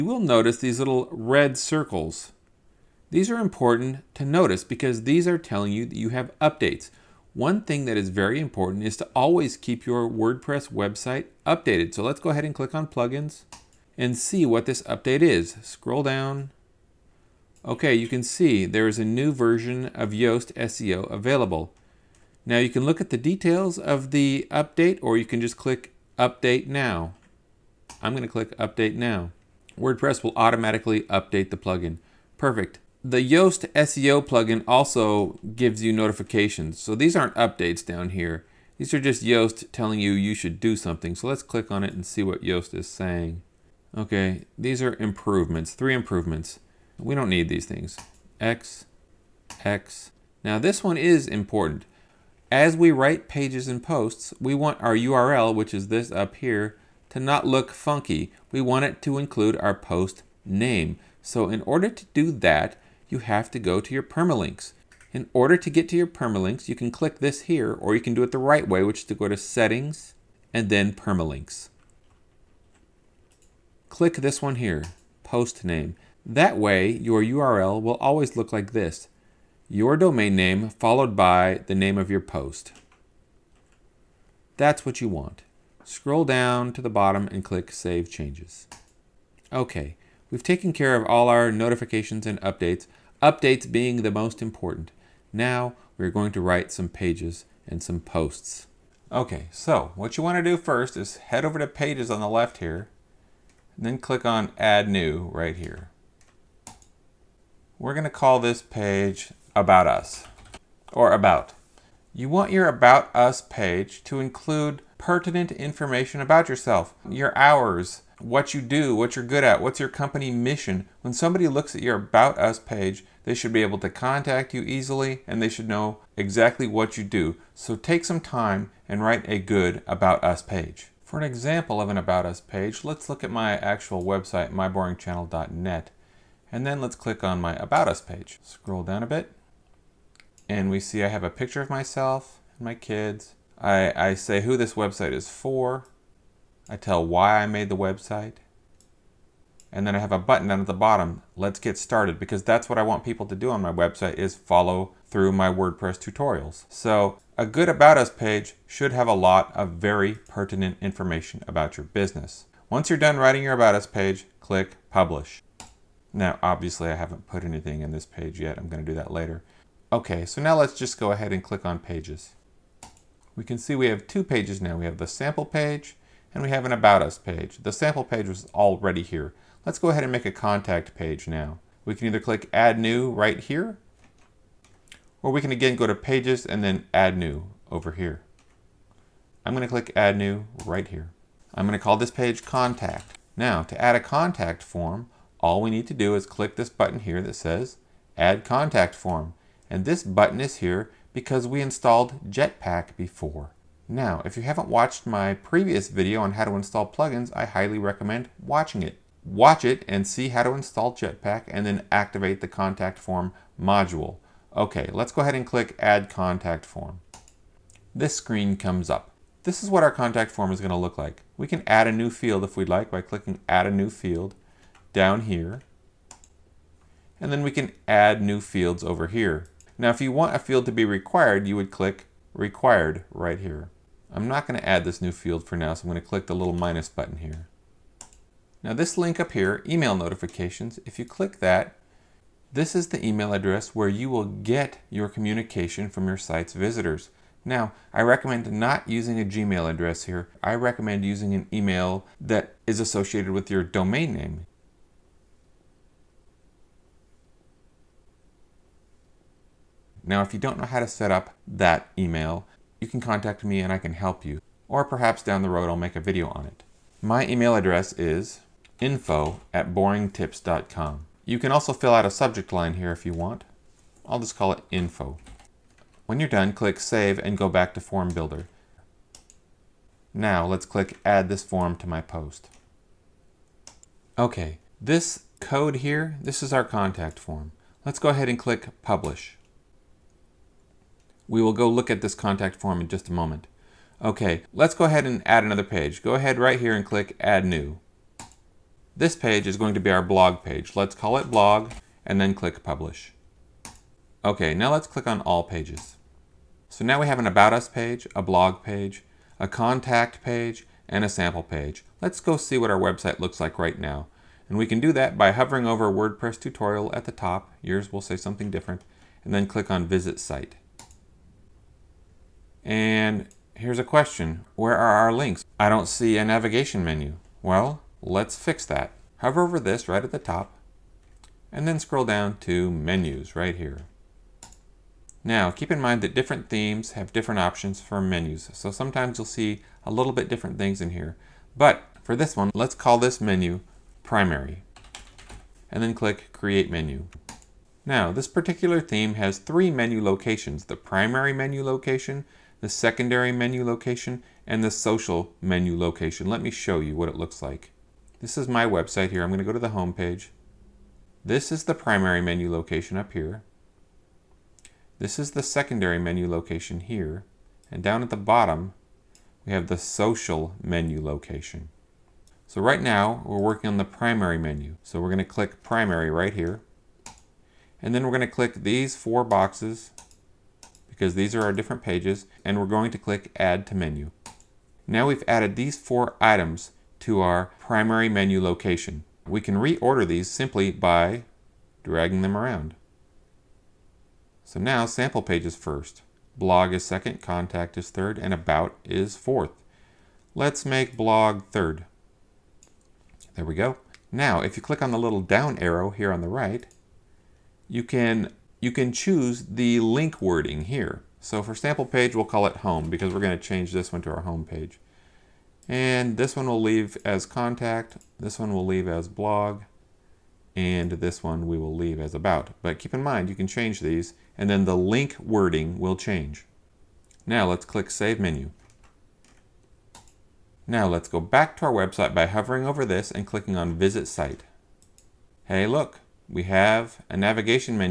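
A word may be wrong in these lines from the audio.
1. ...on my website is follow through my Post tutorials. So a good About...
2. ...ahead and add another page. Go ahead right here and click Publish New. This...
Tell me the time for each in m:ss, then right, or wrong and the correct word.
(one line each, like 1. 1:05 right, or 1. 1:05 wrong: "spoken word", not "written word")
1. 2:33 wrong: "WordPress", not "Post"
2. 4:54 wrong: "Add", not "Publish".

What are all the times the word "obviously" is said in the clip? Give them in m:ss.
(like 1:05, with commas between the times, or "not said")
2:46.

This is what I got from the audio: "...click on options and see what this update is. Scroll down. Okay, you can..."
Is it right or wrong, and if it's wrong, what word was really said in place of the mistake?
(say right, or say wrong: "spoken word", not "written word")
wrong: "plugins", not "options".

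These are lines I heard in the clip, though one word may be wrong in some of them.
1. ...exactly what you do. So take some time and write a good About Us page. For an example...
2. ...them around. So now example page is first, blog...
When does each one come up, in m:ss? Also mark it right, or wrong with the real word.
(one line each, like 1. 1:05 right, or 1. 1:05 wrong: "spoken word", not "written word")
1. 2:06 right
2. 6:32 wrong: "sample", not "example".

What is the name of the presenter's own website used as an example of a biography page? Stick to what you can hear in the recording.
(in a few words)
myboringchannel.net.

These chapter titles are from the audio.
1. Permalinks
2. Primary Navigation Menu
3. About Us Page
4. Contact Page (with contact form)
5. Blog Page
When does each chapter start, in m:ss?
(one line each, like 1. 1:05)
1. 1:00
2. 5:27
3. 1:39
4. 3:08
5. 4:53.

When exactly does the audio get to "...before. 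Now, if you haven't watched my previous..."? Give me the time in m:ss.
3:22.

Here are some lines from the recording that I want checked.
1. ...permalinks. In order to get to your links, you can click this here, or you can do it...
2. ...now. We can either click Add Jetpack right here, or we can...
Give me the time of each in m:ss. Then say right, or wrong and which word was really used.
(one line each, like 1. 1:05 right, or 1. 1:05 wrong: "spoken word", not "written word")
1. 1:04 wrong: "permalinks", not "links"
2. 3:01 wrong: "New", not "Jetpack".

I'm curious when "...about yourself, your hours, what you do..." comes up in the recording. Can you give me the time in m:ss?
1:56.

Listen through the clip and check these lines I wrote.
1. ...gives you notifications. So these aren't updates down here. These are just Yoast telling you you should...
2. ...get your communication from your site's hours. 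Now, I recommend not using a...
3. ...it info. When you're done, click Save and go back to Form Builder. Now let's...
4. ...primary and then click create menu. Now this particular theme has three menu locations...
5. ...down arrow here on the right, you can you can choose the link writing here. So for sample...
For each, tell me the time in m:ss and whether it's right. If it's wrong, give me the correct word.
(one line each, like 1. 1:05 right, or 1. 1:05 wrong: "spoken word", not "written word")
1. 0:35 right
2. 4:04 wrong: "visitors", not "hours"
3. 4:34 right
4. 5:44 right
5. 6:45 wrong: "wording", not "writing".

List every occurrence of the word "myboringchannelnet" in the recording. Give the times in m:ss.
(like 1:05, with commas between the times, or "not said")
2:14.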